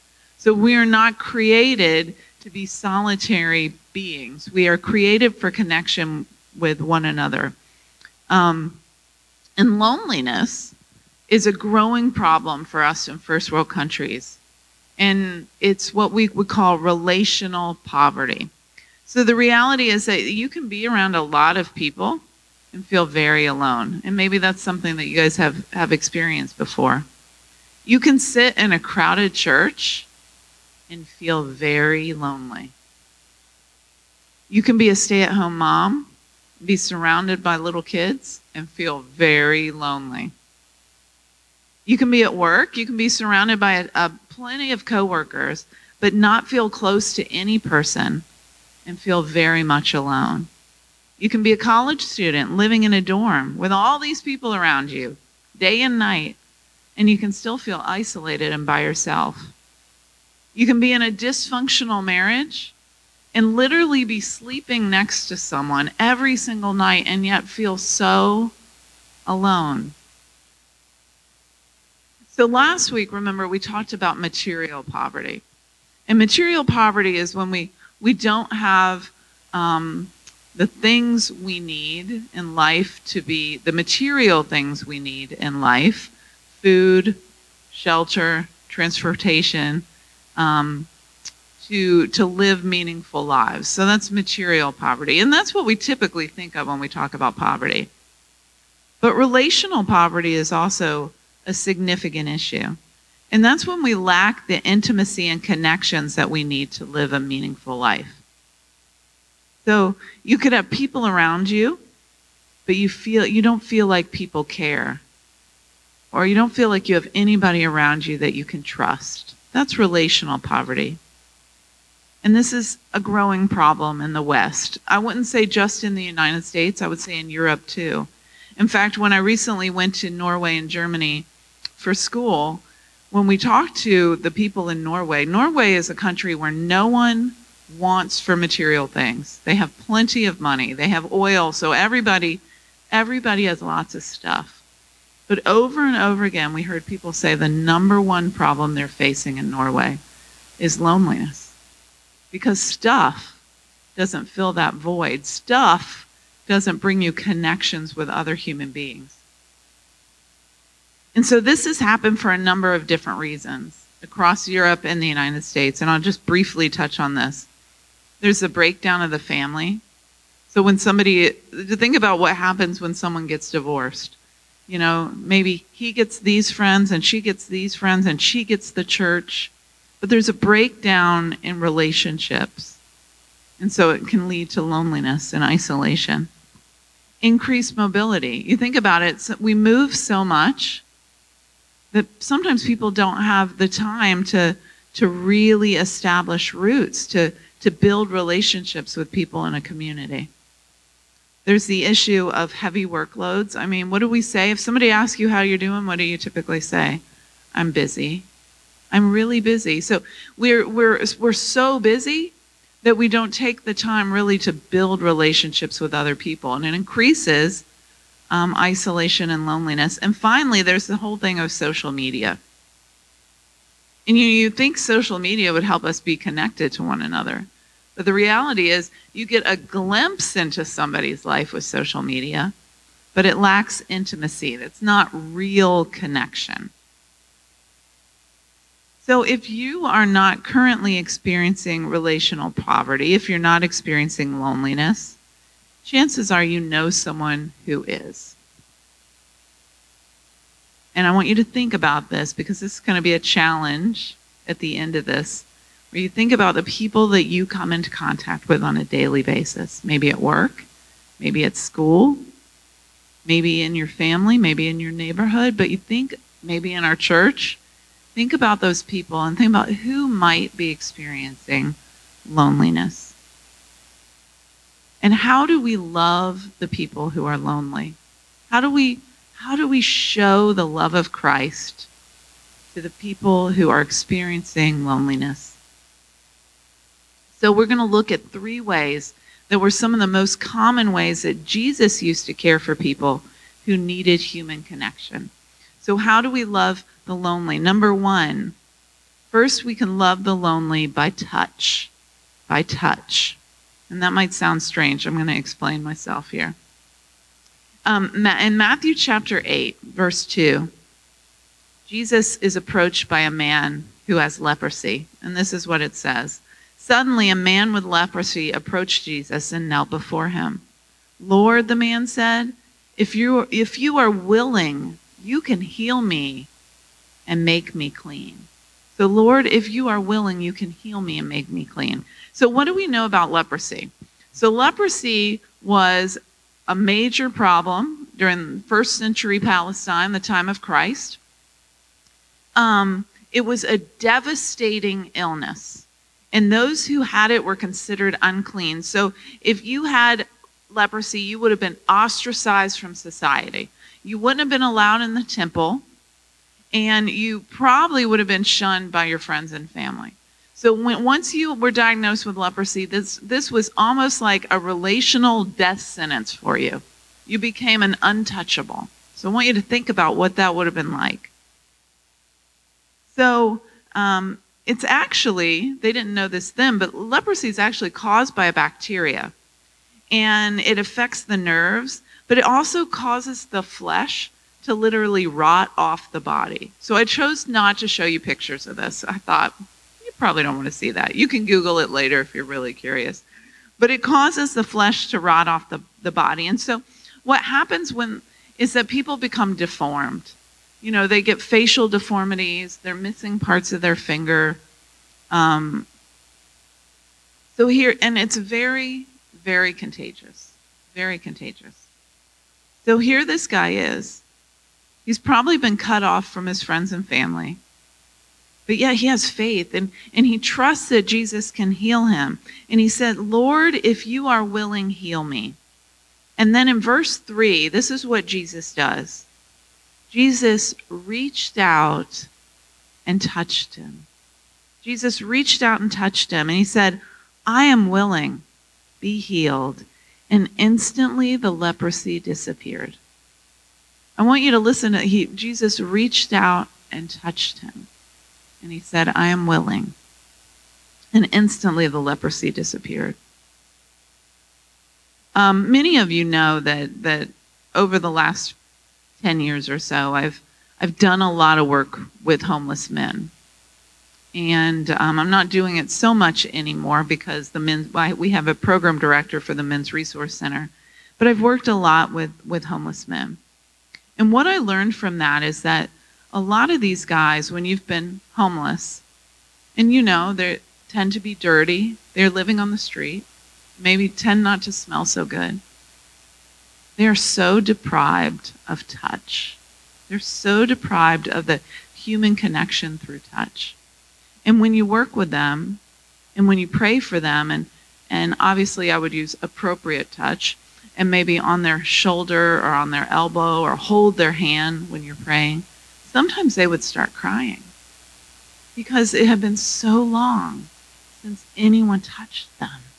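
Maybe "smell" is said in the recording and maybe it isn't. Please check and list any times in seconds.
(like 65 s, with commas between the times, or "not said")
484 s.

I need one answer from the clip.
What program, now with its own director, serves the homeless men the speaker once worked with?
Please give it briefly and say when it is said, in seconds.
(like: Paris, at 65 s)
Men's Resource Center, at 469 s.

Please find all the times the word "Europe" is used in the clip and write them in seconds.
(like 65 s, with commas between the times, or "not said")
127 s, 164 s.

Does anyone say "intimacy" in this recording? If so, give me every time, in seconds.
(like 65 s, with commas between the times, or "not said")
104 s, 233 s.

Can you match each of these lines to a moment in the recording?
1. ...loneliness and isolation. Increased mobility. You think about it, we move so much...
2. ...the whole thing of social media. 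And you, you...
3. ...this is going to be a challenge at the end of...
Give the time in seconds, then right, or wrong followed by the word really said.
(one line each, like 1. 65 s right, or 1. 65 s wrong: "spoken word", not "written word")
1. 184 s right
2. 220 s right
3. 252 s right.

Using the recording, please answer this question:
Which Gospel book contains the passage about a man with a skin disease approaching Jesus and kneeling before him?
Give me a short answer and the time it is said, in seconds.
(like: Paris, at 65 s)
Matthew, at 308 s.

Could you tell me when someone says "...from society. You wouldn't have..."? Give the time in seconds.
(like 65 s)
352 s.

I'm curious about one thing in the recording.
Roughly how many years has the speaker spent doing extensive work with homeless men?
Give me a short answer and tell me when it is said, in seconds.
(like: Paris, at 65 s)
10, at 459 s.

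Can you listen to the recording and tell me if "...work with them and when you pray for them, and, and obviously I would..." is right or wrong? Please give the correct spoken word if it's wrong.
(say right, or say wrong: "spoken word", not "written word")
right.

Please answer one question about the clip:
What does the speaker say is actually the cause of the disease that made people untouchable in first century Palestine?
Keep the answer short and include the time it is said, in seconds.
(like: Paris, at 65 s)
A bacteria, at 378 s.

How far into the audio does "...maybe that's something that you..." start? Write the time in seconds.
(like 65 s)
24 s.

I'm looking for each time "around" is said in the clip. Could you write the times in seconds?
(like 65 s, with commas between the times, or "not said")
20 s, 54 s, 111 s, 117 s.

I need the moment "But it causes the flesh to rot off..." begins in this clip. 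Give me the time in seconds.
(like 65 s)
393 s.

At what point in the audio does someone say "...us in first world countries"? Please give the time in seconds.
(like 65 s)
12 s.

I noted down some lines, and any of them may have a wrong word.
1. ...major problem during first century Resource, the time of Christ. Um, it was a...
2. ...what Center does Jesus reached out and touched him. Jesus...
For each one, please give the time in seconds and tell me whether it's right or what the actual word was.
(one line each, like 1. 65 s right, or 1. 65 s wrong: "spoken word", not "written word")
1. 336 s wrong: "Palestine", not "Resource"
2. 428 s wrong: "Jesus", not "Center".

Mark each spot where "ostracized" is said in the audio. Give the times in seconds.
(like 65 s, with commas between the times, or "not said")
351 s.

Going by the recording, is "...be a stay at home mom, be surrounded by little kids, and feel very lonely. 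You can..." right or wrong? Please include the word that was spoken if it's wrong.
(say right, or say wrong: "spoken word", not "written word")
right.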